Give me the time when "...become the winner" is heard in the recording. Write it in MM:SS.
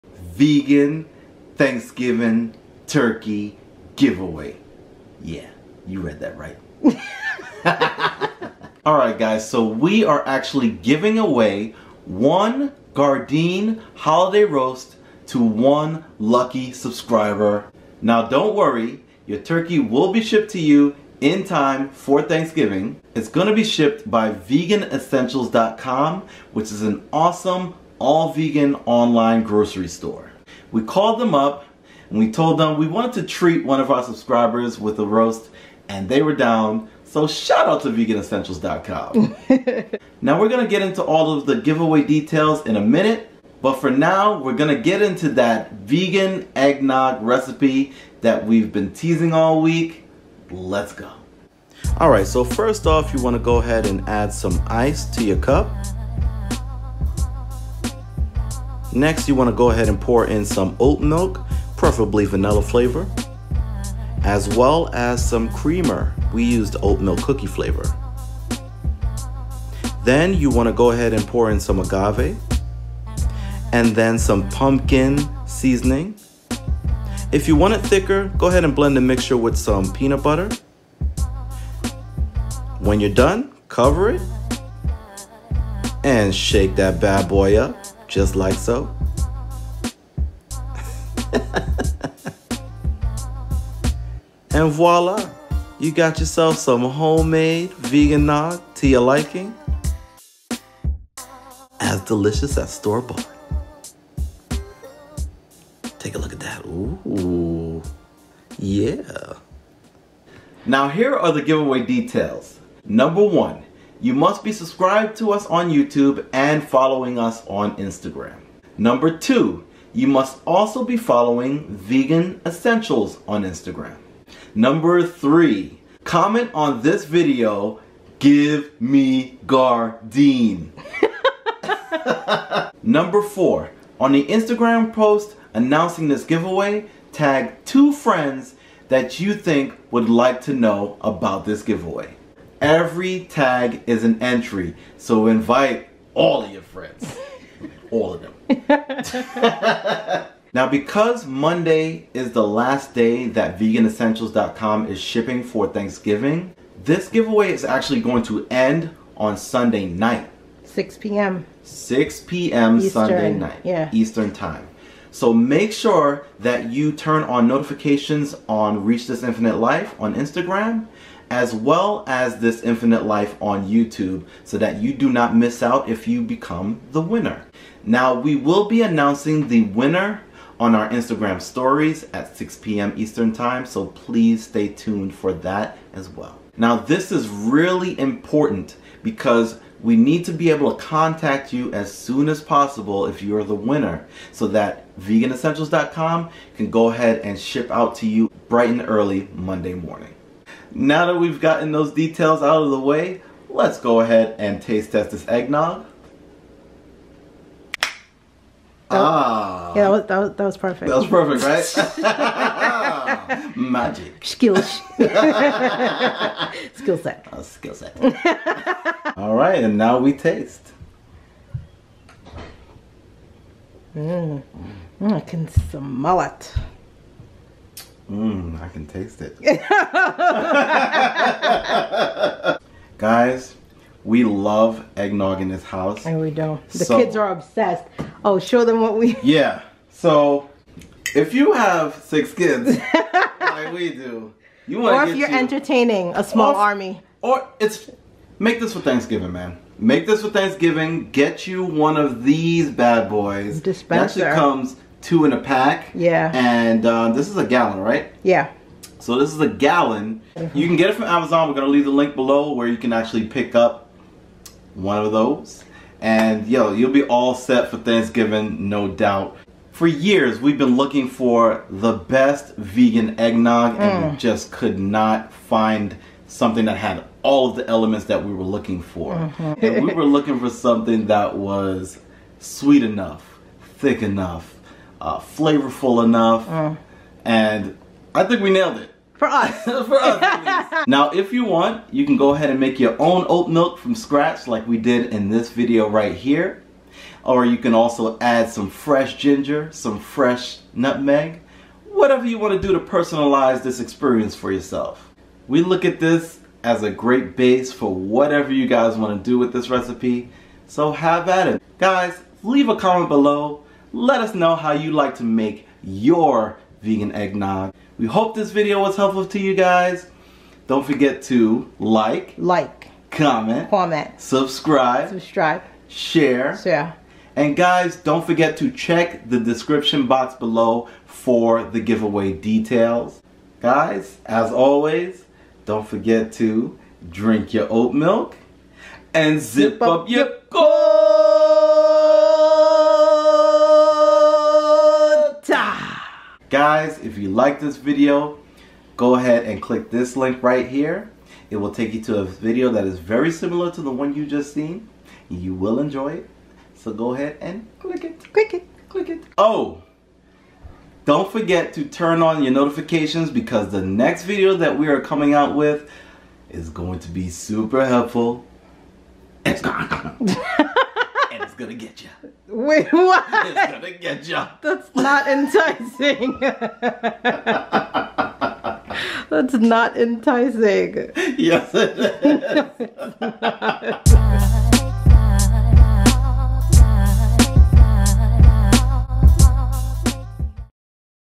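02:56.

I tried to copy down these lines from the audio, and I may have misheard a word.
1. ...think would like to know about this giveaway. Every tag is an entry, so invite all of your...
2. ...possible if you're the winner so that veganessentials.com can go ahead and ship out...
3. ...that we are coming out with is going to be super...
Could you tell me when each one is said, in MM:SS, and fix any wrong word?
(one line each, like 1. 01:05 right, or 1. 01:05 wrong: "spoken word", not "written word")
1. 02:19 right
2. 03:12 right
3. 06:04 right.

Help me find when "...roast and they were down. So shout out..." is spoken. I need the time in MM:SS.
00:35.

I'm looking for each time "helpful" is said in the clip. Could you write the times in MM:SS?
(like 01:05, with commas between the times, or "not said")
05:18, 06:07.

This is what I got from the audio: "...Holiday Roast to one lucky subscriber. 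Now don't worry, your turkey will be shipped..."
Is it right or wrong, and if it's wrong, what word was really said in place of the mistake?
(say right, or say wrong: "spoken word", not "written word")
right.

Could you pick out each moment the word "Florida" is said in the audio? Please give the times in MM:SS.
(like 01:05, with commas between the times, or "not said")
not said.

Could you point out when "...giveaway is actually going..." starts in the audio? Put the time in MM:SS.
02:37.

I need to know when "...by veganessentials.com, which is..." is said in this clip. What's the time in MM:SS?
00:24.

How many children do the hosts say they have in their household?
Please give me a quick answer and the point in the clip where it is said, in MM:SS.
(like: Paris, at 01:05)
6, at 04:02.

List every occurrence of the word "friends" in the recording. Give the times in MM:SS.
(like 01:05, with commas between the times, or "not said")
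02:17, 02:26.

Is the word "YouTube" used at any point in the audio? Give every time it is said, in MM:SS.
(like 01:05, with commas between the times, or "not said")
01:55, 02:53.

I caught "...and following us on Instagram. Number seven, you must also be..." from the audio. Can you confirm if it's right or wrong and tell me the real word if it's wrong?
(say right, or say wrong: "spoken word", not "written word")
wrong: "two", not "seven".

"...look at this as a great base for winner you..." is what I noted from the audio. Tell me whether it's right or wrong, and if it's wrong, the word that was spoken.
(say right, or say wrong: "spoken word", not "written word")
wrong: "whatever", not "winner".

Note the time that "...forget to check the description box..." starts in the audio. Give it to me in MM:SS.
05:28.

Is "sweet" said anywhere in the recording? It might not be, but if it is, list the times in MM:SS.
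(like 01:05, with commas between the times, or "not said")
04:42.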